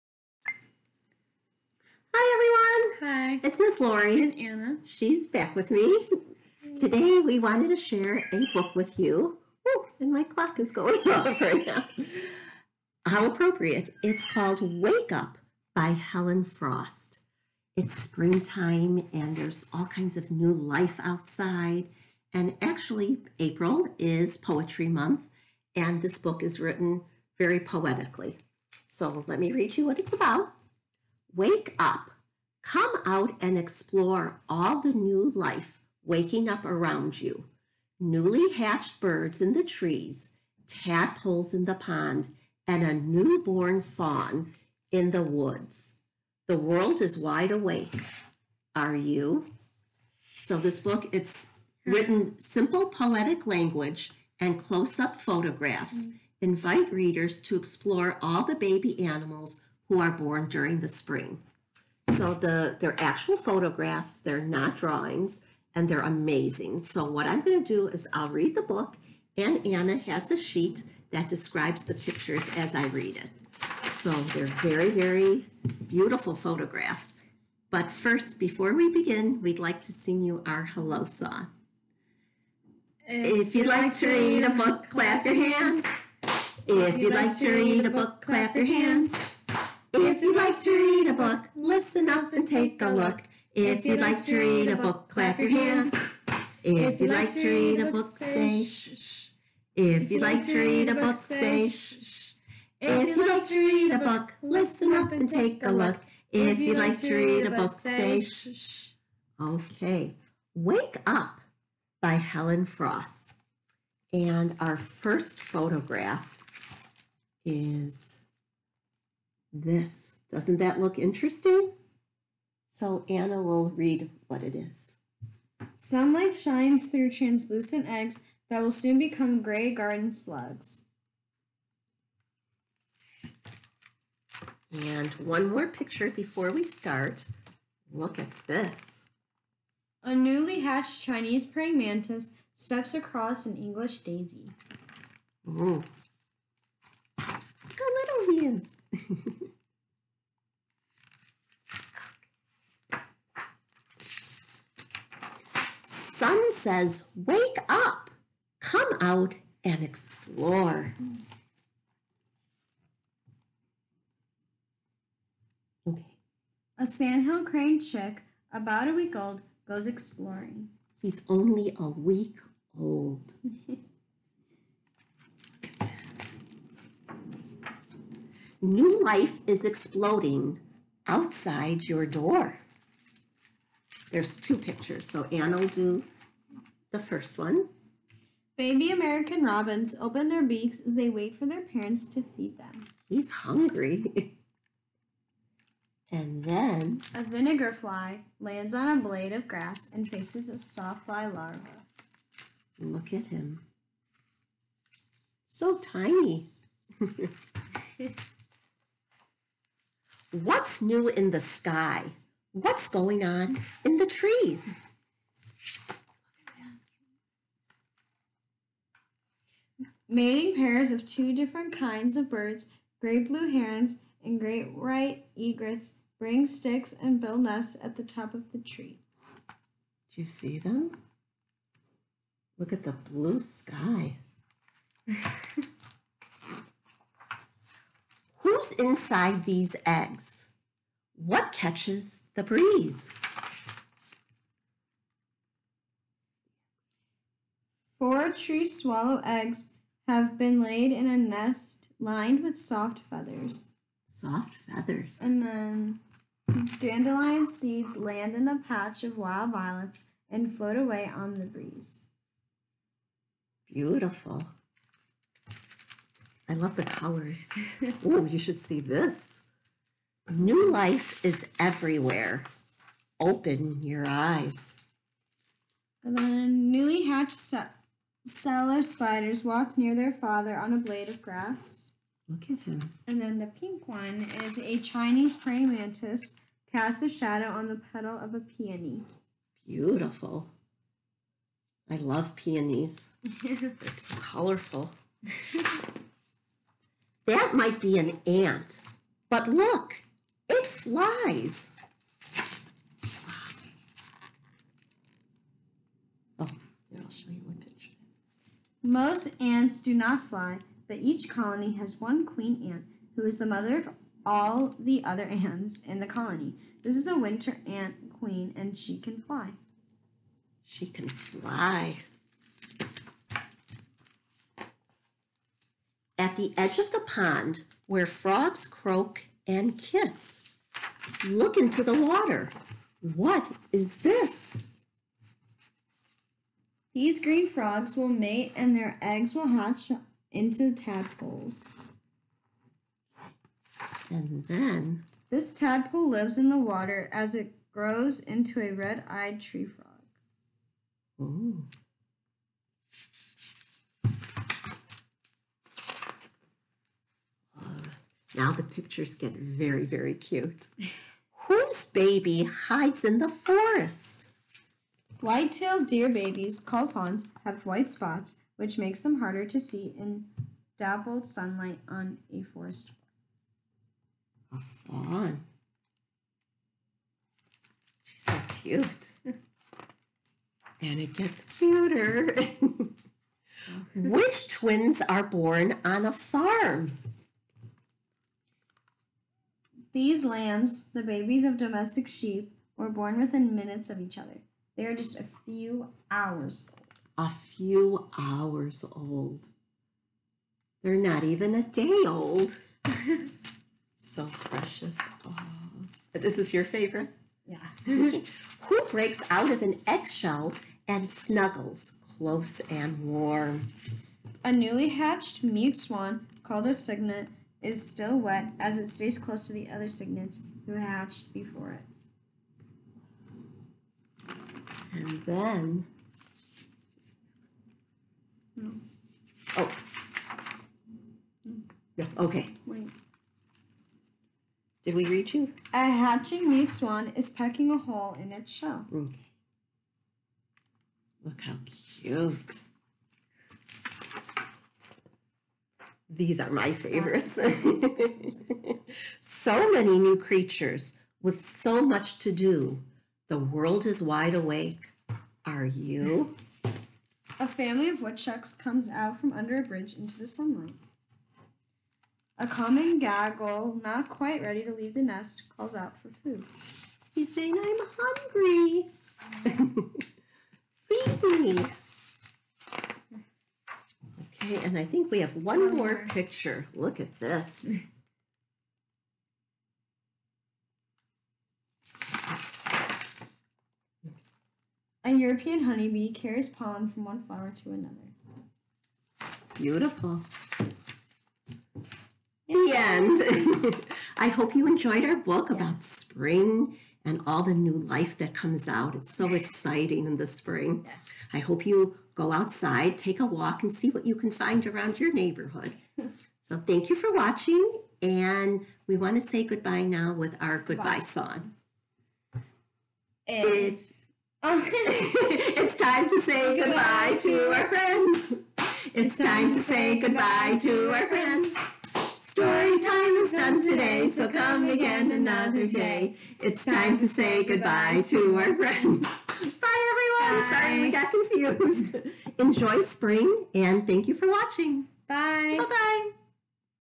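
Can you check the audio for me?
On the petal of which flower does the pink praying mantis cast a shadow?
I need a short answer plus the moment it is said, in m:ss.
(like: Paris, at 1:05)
peony, at 4:48.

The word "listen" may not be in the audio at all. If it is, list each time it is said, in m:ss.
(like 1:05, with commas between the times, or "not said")
1:31, 1:44.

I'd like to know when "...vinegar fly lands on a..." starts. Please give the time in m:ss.
3:17.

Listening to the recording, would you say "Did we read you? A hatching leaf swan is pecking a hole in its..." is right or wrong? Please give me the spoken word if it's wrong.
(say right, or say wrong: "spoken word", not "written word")
right.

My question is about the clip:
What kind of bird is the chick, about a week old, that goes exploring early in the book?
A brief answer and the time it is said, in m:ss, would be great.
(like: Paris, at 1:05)
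sandhill crane, at 2:46.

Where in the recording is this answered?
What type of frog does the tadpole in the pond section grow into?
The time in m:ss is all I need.
5:48.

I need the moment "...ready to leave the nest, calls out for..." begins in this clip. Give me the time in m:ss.
7:44.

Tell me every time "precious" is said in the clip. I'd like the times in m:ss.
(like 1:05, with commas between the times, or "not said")
6:44.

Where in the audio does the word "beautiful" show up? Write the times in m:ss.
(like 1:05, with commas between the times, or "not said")
1:15, 4:23, 4:49, 8:09.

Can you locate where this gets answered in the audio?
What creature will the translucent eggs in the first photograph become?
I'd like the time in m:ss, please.
2:09.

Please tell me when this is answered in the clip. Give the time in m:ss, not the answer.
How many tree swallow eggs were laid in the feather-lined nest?
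4:07.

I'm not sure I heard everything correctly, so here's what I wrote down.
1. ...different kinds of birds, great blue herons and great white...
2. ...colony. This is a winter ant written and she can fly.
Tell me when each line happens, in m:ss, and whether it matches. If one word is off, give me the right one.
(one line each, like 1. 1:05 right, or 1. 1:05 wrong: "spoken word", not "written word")
1. 3:41 right
2. 5:16 wrong: "queen", not "written".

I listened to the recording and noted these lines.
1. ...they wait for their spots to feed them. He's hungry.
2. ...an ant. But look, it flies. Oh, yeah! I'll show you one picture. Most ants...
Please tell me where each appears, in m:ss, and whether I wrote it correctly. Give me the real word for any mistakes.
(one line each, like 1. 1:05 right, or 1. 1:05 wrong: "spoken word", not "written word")
1. 3:10 wrong: "parents", not "spots"
2. 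4:57 right.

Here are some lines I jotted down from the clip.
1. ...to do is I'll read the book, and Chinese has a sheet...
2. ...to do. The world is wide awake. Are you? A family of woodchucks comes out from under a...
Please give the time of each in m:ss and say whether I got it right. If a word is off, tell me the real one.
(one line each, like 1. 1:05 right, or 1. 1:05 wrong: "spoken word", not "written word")
1. 1:07 wrong: "Anna", not "Chinese"
2. 7:32 right.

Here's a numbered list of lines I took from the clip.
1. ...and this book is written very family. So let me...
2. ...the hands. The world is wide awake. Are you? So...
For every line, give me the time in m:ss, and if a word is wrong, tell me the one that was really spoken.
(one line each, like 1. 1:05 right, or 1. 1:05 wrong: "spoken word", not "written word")
1. 0:25 wrong: "poetically", not "family"
2. 0:45 wrong: "woods", not "hands".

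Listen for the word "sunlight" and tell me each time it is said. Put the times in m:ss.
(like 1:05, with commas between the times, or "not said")
2:05, 6:11, 7:40.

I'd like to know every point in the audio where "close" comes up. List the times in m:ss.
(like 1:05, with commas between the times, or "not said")
0:54, 6:52, 6:59.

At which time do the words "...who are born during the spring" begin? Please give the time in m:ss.
0:59.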